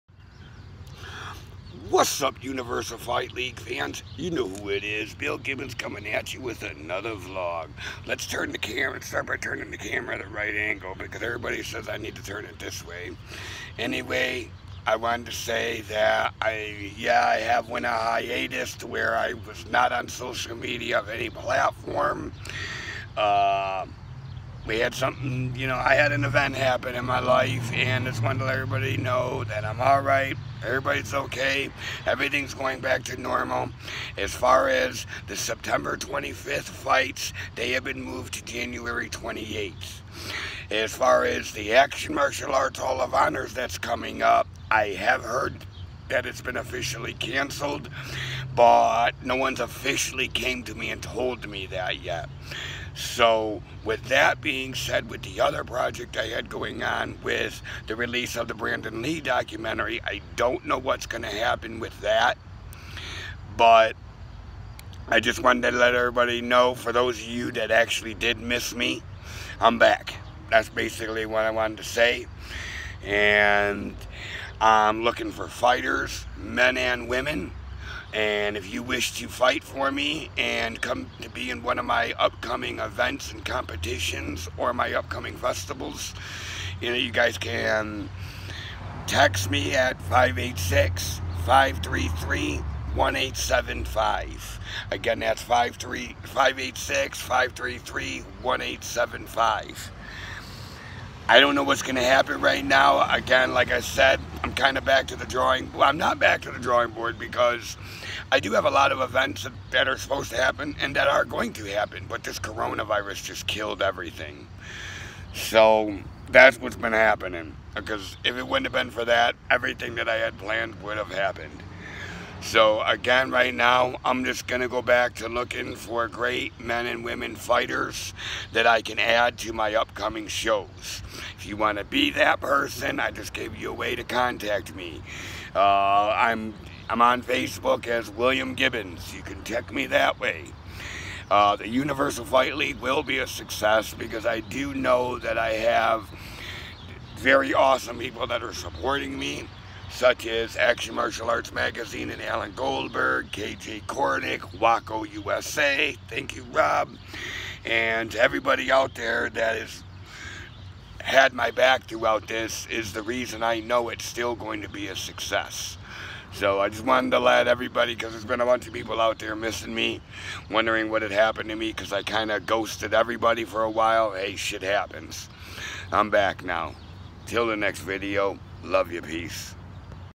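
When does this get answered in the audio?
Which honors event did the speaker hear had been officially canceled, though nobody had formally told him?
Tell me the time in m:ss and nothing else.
0:41.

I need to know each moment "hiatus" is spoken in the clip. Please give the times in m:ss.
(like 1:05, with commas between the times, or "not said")
0:17.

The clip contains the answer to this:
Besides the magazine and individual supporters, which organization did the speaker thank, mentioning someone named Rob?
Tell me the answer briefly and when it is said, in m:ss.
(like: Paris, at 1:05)
WAKO USA, at 2:34.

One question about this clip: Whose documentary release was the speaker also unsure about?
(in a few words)
Brandon Lee.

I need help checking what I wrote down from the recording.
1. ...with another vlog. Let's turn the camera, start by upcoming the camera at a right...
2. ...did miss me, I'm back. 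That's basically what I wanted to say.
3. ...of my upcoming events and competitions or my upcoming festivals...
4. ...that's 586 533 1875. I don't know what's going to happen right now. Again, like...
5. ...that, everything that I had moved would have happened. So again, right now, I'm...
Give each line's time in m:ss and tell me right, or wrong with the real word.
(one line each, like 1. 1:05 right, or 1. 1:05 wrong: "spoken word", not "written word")
1. 0:06 wrong: "turning", not "upcoming"
2. 1:08 right
3. 1:21 right
4. 1:35 right
5. 1:59 wrong: "planned", not "moved".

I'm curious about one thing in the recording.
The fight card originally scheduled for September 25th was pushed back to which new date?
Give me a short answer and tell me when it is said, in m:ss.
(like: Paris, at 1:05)
January 28th, at 0:38.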